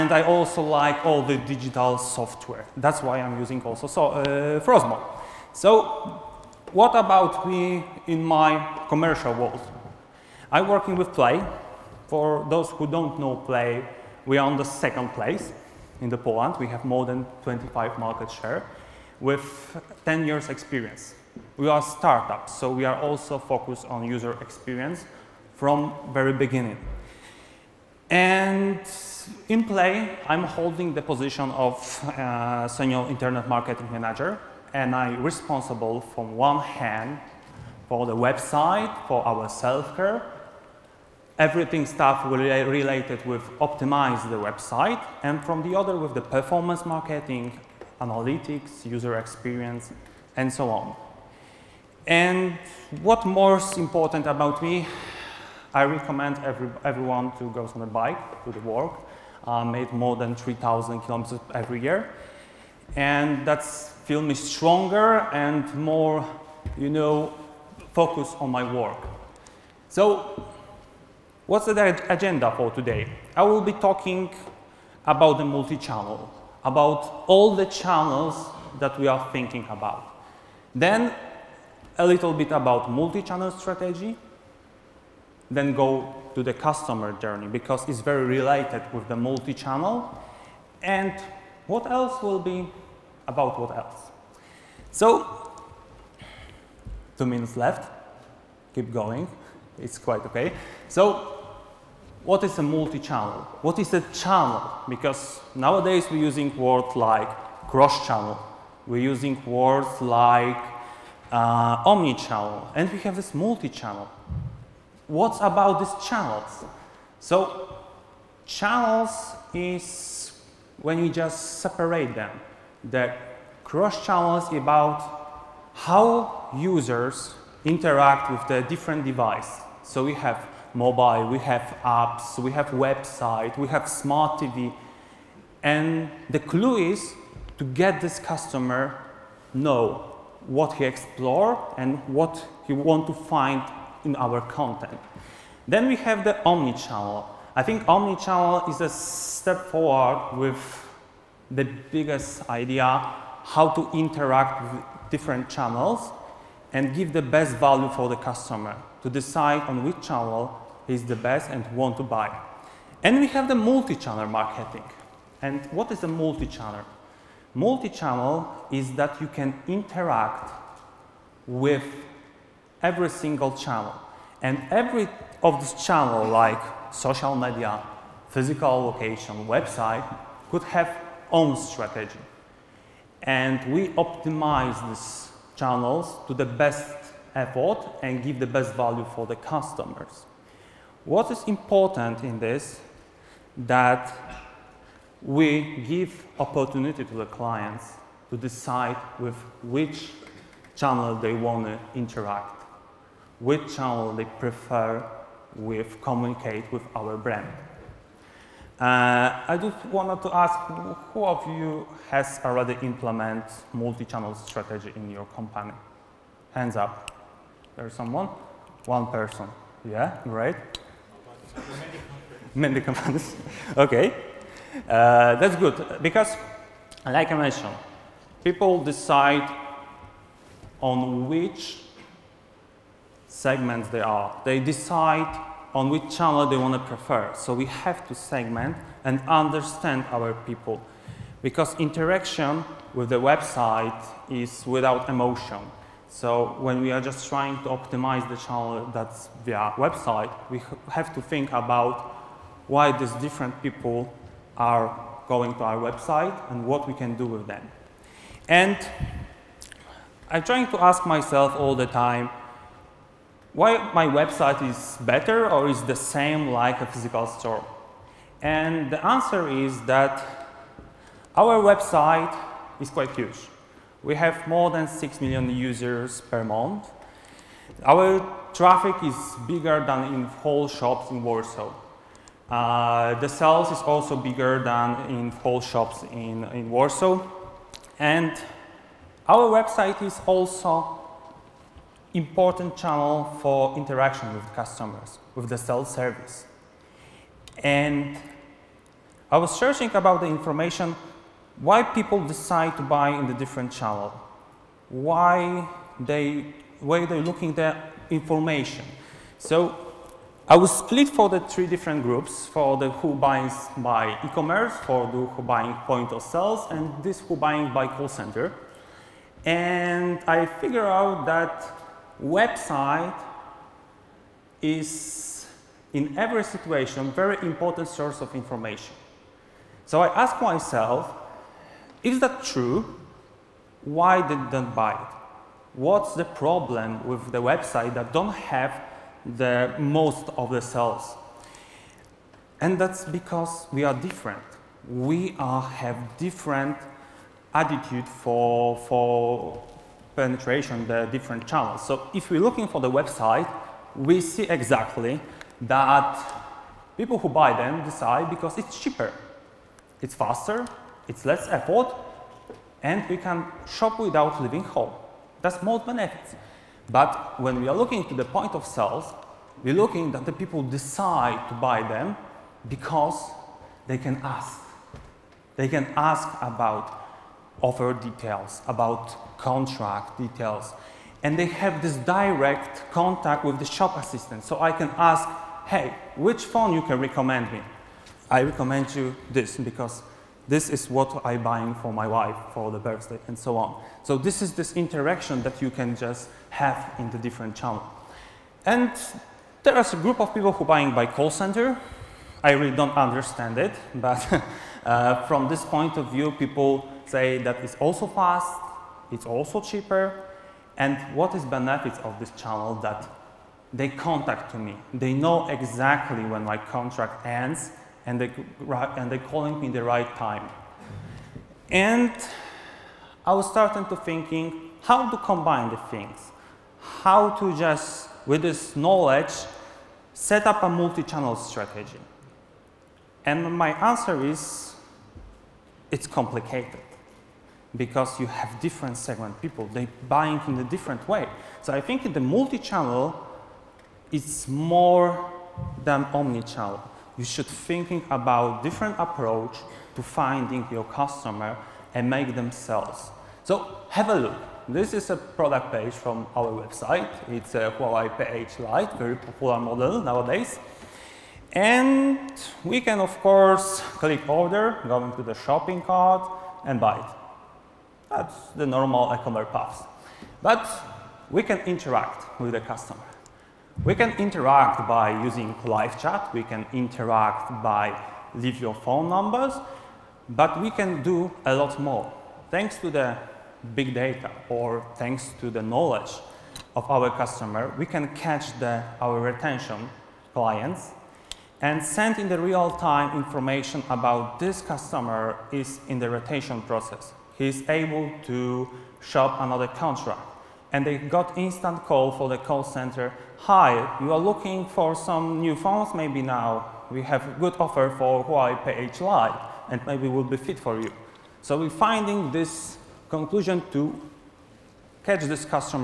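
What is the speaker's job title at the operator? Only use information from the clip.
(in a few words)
Senior internet marketing manager.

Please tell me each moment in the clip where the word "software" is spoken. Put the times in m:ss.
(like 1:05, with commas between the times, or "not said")
0:01.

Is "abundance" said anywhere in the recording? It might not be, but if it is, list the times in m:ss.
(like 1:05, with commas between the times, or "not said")
not said.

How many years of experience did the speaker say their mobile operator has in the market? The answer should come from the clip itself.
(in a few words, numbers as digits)
10 years.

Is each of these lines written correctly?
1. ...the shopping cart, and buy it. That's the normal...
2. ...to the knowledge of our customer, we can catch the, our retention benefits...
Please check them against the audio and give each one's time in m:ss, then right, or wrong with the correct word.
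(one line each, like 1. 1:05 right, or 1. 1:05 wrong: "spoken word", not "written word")
1. 7:45 right
2. 8:05 wrong: "clients", not "benefits".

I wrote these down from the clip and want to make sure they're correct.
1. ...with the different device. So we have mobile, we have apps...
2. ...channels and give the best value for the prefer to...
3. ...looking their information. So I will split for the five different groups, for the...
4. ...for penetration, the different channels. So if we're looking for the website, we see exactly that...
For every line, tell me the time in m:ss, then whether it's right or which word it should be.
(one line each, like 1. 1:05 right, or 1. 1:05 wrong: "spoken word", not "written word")
1. 2:08 right
2. 2:35 wrong: "customer", not "prefer"
3. 5:07 wrong: "three", not "five"
4. 5:48 right.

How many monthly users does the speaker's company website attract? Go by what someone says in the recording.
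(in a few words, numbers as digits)
6 million.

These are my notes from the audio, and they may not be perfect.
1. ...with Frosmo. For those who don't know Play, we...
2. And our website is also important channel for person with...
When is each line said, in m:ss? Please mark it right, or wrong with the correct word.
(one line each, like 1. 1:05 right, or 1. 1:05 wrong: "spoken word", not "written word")
1. 0:10 wrong: "Play", not "Frosmo"
2. 4:47 wrong: "interaction", not "person".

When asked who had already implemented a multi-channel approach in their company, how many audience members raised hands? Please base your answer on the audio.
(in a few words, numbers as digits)
1.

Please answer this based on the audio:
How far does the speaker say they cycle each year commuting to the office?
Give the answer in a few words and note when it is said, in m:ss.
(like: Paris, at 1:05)
3,000 kilometers, at 1:00.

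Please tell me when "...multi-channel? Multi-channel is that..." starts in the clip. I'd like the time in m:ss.
2:46.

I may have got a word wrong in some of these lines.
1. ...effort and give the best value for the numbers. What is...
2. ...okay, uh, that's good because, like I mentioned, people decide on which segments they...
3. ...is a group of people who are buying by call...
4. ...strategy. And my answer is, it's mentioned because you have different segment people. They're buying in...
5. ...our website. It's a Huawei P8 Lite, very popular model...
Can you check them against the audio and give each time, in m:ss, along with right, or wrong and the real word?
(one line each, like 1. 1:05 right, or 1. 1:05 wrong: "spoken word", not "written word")
1. 3:07 wrong: "customers", not "numbers"
2. 3:43 right
3. 6:39 right
4. 7:11 wrong: "complicated", not "mentioned"
5. 7:36 right.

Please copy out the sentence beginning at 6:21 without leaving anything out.
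And they have this direct contact with the shop assistant.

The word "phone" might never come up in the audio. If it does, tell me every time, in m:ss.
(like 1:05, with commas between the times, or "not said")
6:26, 7:58, 8:25.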